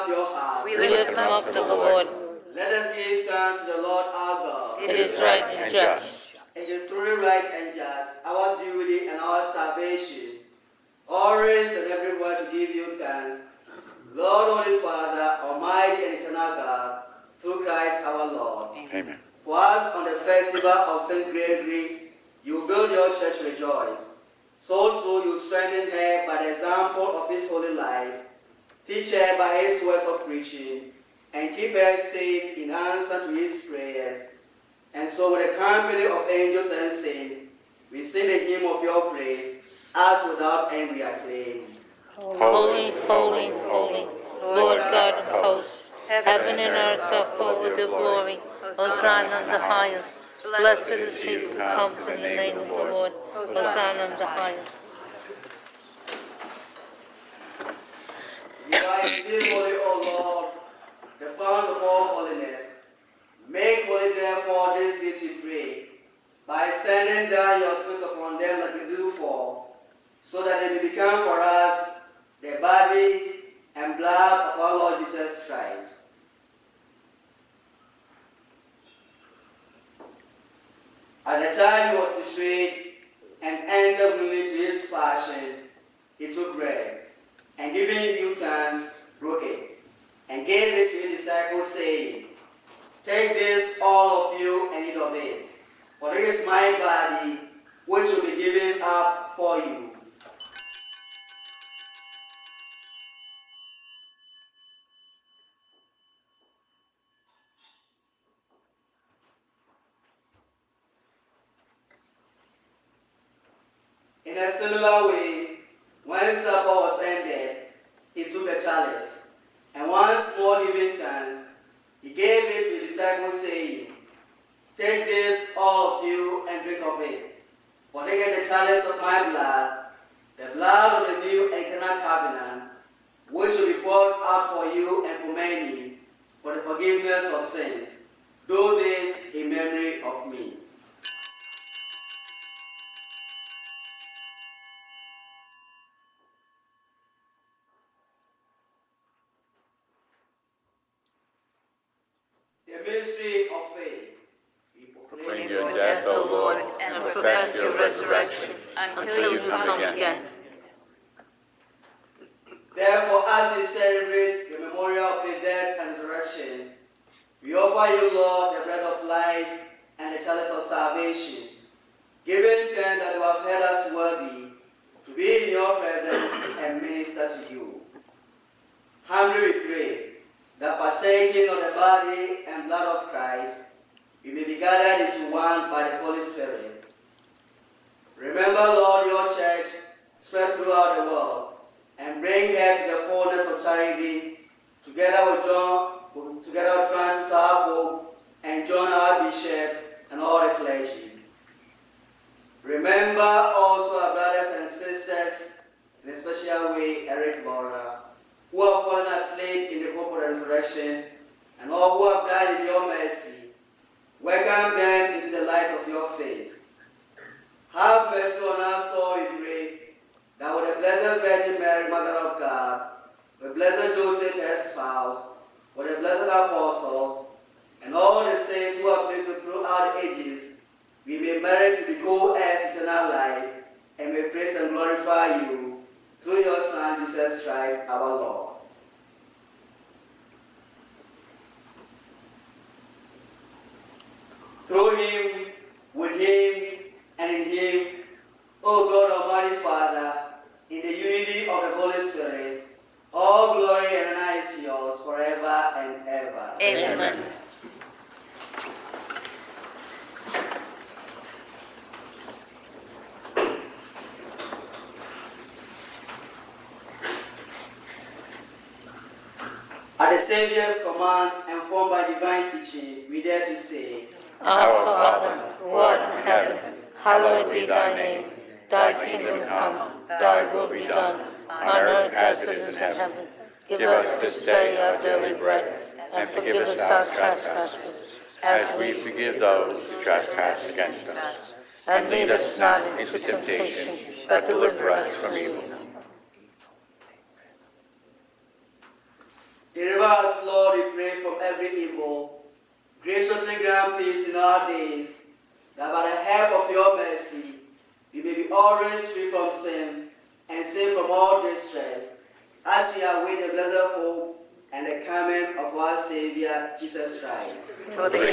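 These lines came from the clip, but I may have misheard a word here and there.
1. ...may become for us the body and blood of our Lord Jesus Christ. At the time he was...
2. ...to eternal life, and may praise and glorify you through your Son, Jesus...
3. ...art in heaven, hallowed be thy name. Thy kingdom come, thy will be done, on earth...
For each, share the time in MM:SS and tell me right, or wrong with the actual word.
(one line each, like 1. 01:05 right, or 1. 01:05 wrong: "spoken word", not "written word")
1. 01:10 right
2. 03:52 right
3. 04:35 right.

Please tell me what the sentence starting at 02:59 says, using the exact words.
Humbly we pray that partaking of the body and blood of Christ, you may be gathered into one by the Holy Spirit.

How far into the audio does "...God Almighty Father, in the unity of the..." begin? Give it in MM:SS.
04:08.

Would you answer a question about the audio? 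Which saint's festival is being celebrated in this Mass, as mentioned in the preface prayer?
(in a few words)
St. Gregory.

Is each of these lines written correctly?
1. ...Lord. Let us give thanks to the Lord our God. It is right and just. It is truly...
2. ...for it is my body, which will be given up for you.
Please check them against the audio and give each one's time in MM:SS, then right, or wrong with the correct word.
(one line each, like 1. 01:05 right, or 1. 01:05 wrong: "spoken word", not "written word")
1. 00:01 right
2. 01:36 right.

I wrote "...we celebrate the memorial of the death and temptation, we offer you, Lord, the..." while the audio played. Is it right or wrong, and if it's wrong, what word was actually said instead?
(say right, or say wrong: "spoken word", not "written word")
wrong: "resurrection", not "temptation".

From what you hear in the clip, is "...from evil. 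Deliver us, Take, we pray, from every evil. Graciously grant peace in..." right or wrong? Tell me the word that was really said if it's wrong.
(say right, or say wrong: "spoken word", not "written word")
wrong: "Lord", not "Take".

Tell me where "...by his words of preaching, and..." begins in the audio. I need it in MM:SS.
00:29.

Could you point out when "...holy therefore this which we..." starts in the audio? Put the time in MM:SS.
01:03.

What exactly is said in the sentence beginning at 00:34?
And so with the company of angels and saints, we sing the hymn of your praise, as without end we acclaim.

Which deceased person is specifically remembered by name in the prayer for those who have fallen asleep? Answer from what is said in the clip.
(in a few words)
Eric Mora.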